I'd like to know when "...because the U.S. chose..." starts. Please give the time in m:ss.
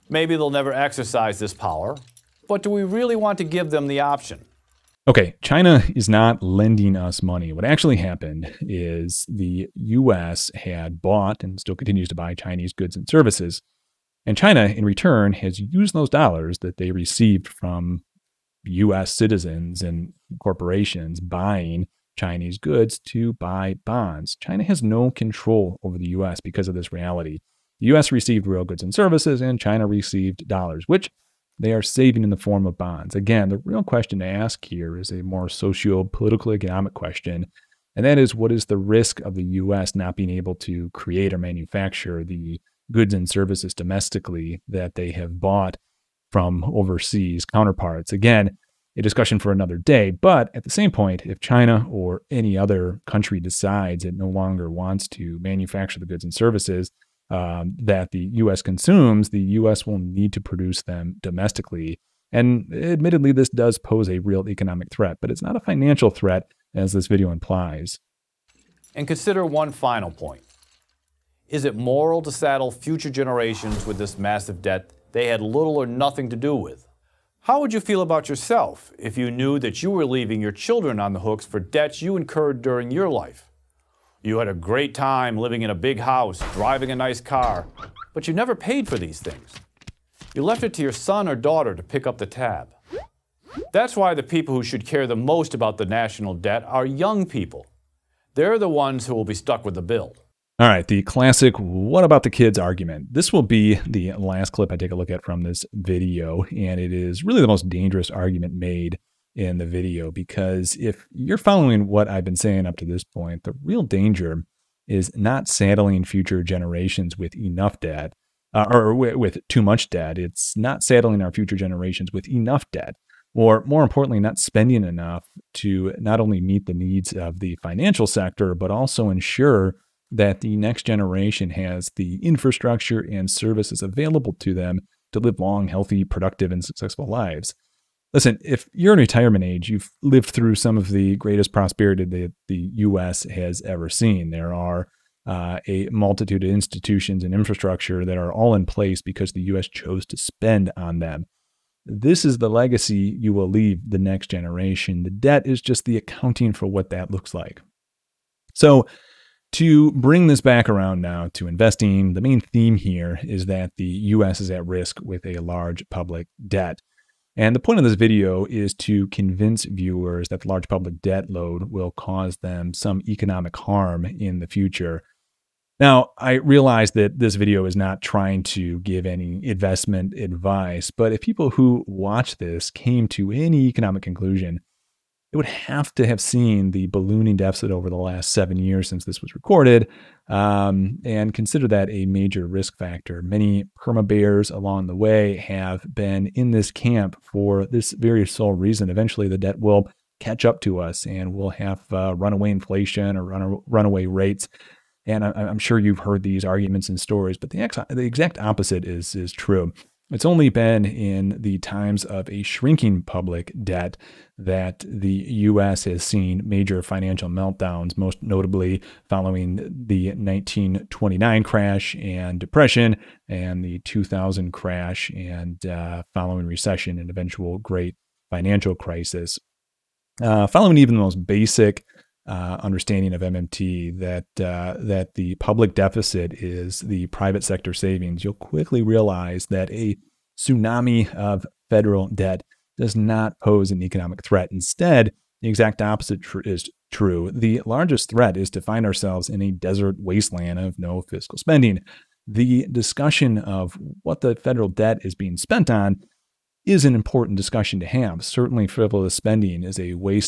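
2:29.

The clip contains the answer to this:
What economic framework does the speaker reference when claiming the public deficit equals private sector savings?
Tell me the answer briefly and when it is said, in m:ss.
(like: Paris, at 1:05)
MMT, at 3:53.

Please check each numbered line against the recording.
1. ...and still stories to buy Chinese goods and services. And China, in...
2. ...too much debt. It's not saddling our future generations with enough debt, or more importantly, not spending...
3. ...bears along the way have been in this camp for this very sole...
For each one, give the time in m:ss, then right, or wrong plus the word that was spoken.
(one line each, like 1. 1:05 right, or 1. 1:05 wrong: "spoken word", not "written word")
1. 0:11 wrong: "continues", not "stories"
2. 1:59 right
3. 3:14 right.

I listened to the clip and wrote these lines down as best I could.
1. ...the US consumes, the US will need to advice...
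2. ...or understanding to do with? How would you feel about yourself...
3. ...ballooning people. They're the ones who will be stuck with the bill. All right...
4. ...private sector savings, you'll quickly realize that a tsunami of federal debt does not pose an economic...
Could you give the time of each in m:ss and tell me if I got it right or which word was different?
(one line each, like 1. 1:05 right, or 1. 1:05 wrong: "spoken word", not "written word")
1. 0:58 wrong: "produce", not "advice"
2. 1:15 wrong: "nothing", not "understanding"
3. 1:36 wrong: "young", not "ballooning"
4. 3:57 right.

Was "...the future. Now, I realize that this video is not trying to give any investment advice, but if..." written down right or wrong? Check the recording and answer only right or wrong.
right.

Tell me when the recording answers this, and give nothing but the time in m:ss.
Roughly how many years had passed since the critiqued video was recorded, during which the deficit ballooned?
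3:08.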